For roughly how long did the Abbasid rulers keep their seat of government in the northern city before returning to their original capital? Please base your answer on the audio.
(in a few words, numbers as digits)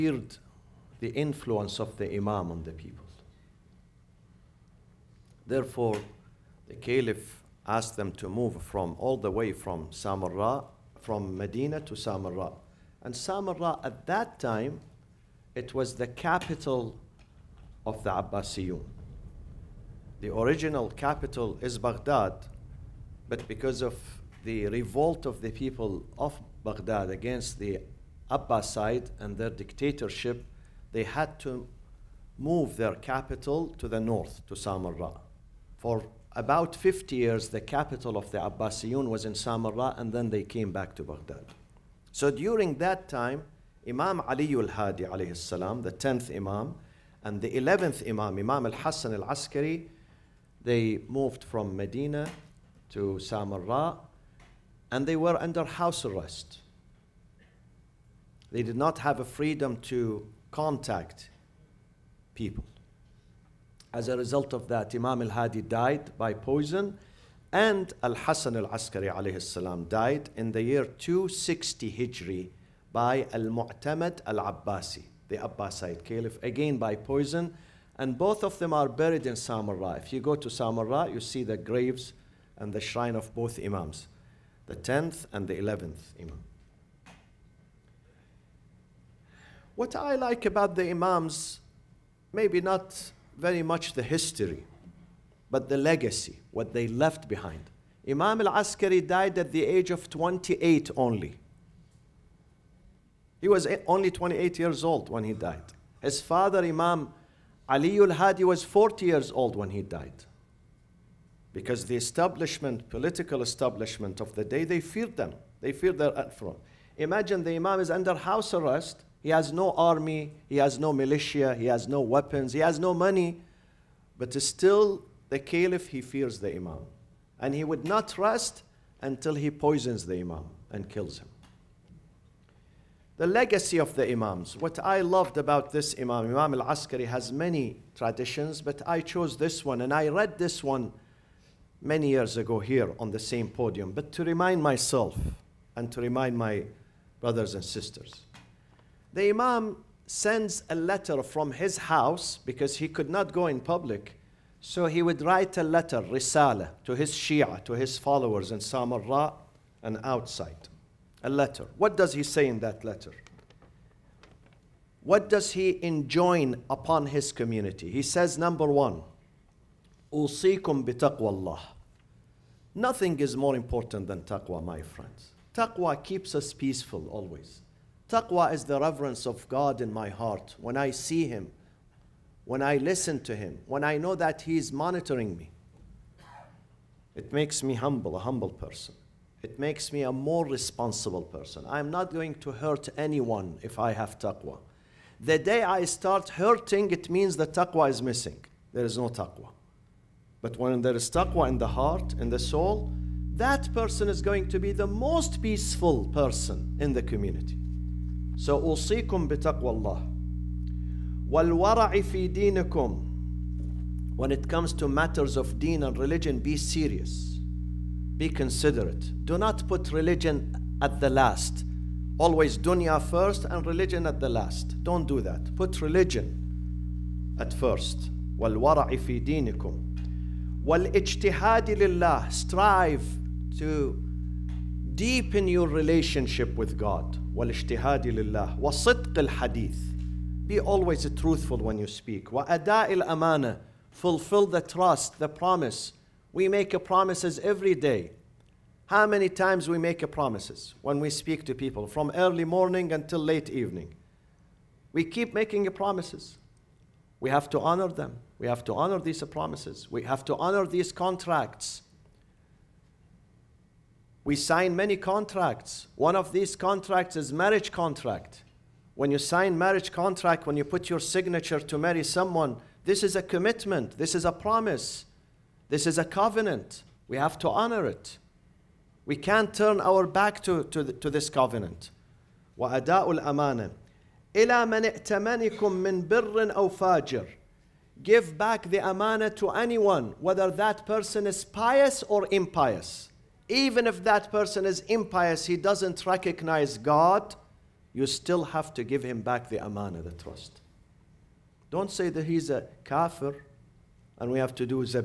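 50 years.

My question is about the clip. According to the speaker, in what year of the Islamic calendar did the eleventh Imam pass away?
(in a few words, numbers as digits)
260 Hijri.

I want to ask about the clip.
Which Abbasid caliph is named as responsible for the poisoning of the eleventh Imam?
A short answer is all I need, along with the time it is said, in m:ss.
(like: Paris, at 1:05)
Al-Mu'tamad al-Abbasi, at 1:13.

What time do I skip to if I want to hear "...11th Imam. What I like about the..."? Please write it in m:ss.
1:25.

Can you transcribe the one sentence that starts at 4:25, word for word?
One of these contracts is marriage contract.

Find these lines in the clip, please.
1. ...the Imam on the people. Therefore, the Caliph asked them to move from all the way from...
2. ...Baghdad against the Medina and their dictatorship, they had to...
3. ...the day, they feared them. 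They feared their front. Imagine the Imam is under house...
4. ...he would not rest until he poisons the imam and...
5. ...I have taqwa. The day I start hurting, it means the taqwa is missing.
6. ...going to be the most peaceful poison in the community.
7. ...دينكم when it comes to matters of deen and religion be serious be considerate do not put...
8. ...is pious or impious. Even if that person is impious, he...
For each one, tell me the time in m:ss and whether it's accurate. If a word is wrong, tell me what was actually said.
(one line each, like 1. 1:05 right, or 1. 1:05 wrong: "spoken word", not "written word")
1. 0:01 right
2. 0:26 wrong: "Abbasid", not "Medina"
3. 1:54 right
4. 2:07 right
5. 3:13 right
6. 3:24 wrong: "person", not "poison"
7. 3:32 right
8. 4:51 right.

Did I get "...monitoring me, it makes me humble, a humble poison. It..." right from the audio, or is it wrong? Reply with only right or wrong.
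wrong.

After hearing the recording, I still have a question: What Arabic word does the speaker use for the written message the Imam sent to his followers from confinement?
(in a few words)
risala.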